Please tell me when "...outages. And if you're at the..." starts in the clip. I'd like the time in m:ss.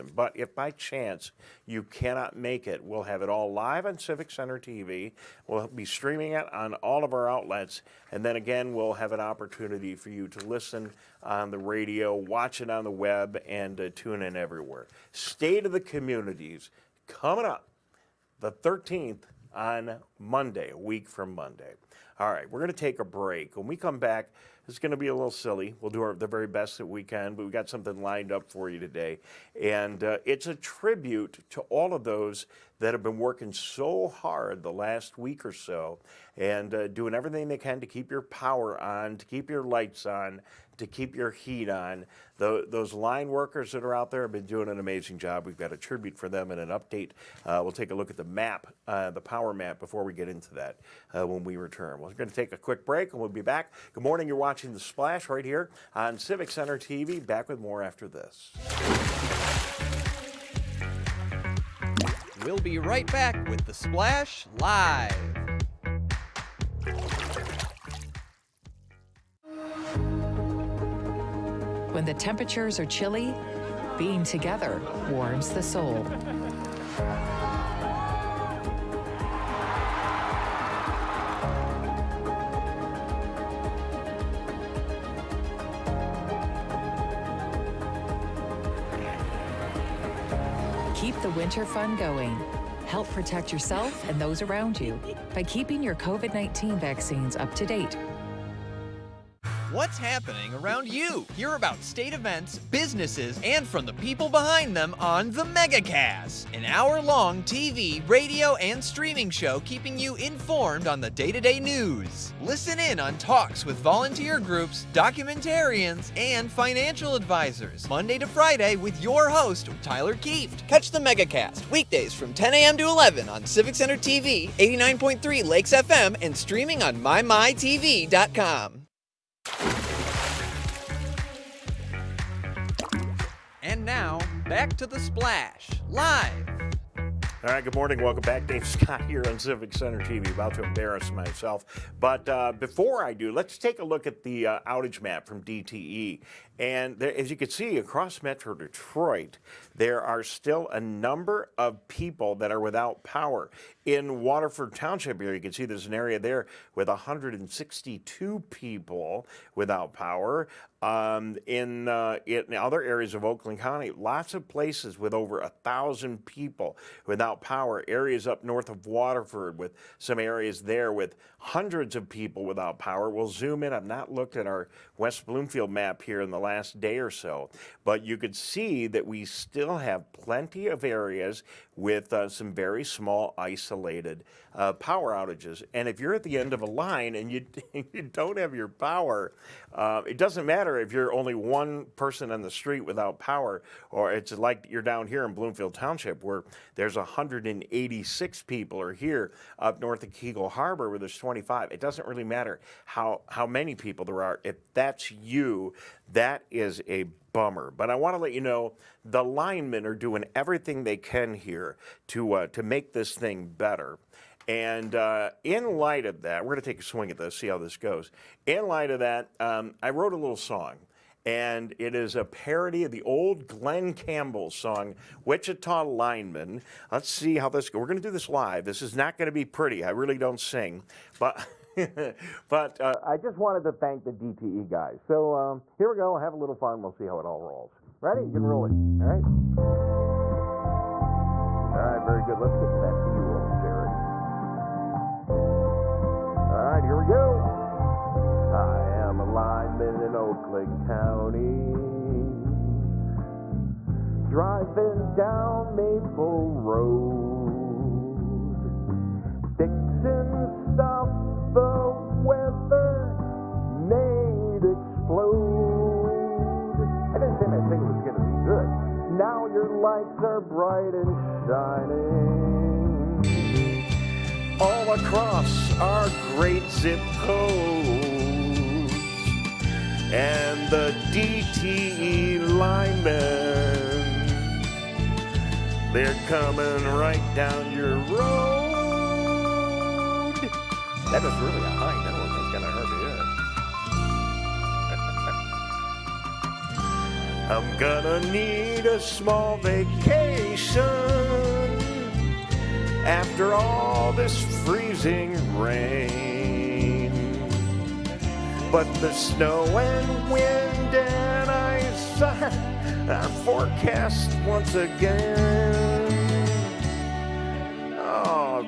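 3:05.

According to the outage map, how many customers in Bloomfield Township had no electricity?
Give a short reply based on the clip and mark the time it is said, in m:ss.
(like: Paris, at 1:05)
186, at 3:16.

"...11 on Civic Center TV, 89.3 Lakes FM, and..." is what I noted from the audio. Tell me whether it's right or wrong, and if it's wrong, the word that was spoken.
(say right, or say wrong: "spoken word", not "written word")
right.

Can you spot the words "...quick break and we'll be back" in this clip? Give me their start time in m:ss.
0:52.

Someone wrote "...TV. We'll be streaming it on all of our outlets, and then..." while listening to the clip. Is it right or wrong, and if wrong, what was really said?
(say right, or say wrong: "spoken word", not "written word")
right.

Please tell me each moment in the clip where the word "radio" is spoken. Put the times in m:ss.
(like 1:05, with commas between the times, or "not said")
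0:11, 1:48.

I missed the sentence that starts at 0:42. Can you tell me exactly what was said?
The, those line workers that are out there have been doing an amazing job.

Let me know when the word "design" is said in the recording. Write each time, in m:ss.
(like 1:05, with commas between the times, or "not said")
not said.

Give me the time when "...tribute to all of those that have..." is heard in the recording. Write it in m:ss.
0:30.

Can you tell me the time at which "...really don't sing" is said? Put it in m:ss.
3:49.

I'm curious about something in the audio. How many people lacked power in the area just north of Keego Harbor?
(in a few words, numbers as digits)
25.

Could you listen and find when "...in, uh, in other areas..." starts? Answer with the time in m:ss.
2:41.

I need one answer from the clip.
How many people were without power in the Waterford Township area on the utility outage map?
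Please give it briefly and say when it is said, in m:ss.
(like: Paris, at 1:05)
162, at 2:36.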